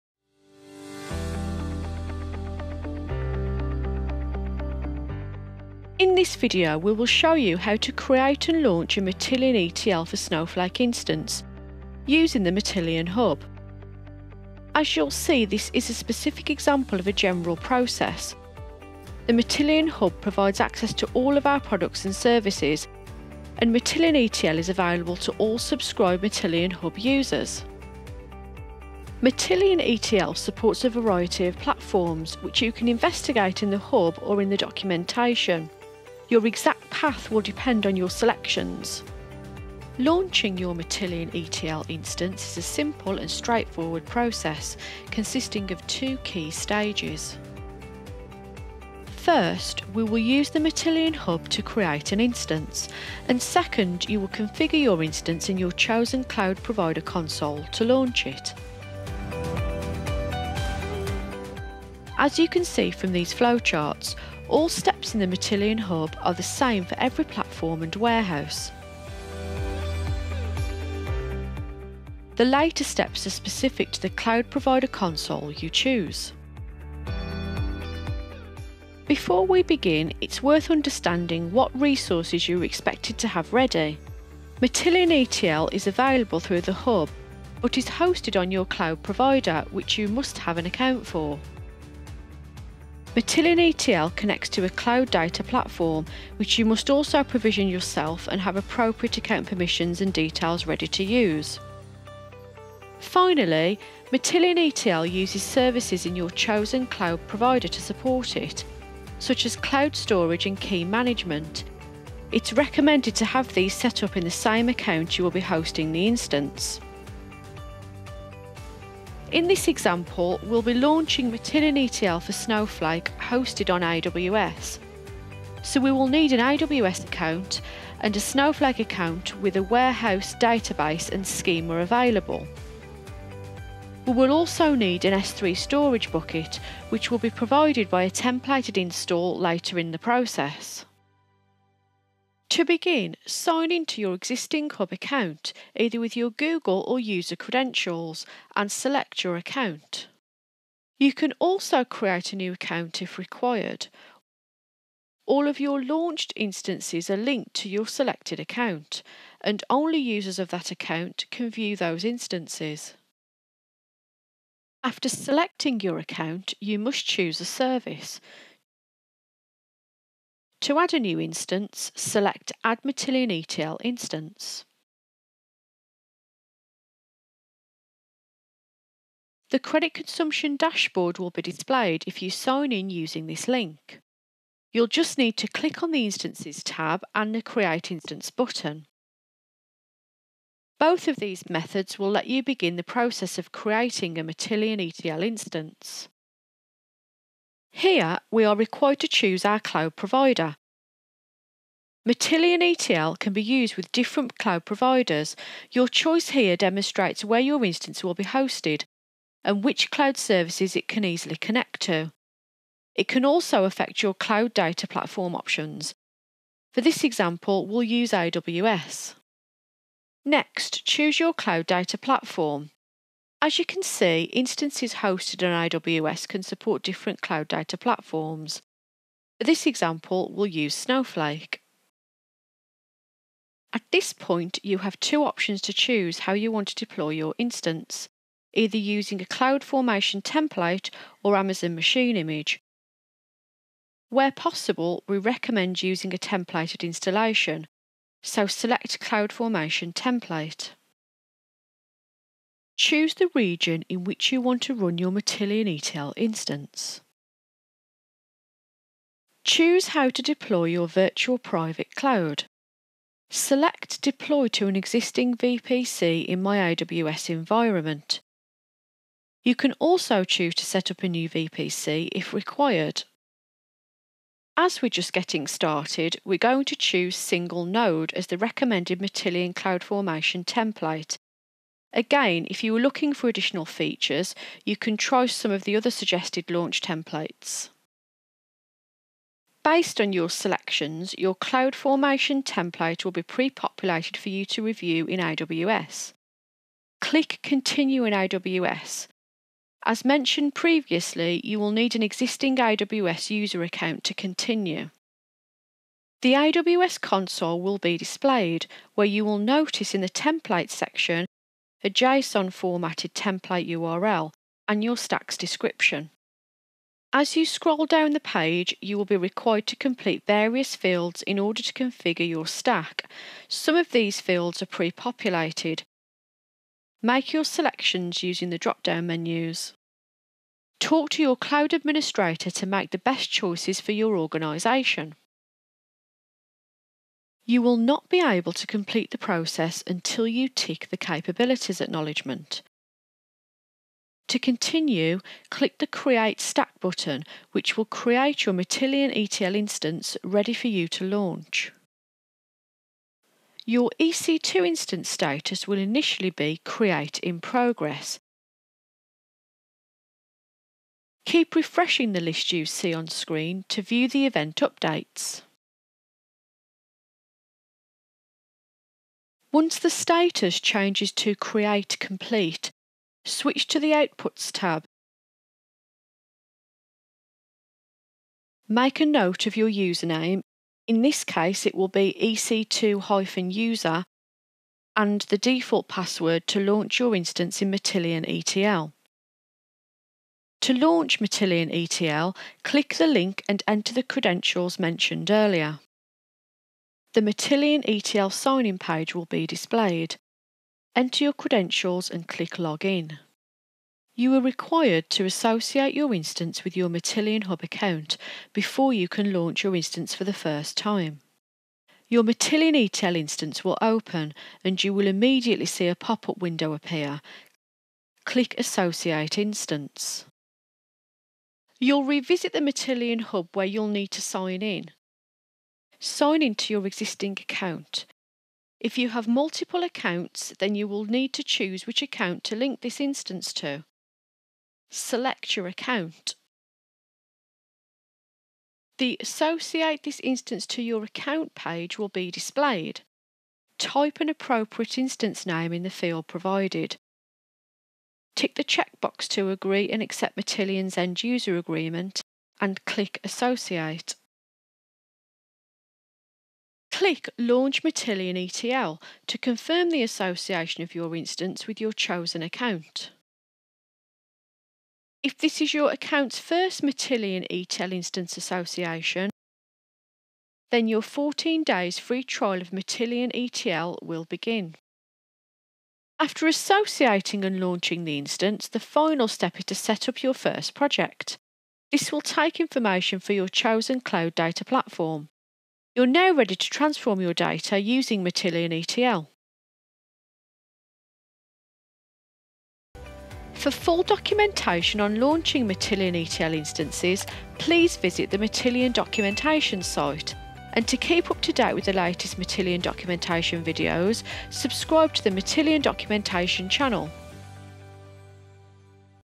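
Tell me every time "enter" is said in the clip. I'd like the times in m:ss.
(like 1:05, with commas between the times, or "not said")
6:33, 6:40.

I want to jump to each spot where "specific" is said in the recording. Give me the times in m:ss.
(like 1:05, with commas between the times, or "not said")
0:15, 1:13.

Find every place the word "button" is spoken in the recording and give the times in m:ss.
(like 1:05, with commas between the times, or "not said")
3:08, 5:46.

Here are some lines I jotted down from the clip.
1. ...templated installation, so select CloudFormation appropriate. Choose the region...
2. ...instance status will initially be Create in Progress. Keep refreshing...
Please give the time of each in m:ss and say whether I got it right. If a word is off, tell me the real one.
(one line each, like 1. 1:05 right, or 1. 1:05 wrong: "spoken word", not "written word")
1. 4:06 wrong: "template", not "appropriate"
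2. 5:54 right.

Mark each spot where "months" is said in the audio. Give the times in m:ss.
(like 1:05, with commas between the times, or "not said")
not said.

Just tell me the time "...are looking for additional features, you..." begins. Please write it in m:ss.
4:42.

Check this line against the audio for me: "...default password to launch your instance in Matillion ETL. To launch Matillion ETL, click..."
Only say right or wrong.
right.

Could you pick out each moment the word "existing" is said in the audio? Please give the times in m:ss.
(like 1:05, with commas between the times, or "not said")
2:24, 4:24, 5:02, 7:06.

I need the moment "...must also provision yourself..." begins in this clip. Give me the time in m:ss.
1:36.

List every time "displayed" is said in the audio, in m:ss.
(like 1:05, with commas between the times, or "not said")
3:01, 5:07, 6:39, 7:22.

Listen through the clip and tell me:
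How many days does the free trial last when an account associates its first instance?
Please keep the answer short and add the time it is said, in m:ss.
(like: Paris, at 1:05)
14, at 7:51.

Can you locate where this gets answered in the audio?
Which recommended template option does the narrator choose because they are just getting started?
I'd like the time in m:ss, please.
4:37.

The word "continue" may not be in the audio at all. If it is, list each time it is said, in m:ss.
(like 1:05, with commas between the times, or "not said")
4:57, 5:04, 5:44.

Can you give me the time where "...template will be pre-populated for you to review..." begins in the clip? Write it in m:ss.
4:52.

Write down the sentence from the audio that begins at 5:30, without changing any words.
Talk to your cloud administrator to make the best choices for your organisation.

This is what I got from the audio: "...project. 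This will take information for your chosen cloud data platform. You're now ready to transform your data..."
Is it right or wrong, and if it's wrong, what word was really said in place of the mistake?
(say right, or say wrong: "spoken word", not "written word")
right.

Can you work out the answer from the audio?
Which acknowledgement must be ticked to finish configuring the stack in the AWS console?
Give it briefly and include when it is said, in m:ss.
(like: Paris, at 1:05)
Capabilities acknowledgement, at 5:40.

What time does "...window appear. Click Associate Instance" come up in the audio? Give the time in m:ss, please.
6:56.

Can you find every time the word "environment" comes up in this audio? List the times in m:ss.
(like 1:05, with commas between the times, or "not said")
4:27.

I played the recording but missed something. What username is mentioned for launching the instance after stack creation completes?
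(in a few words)
ec2-user.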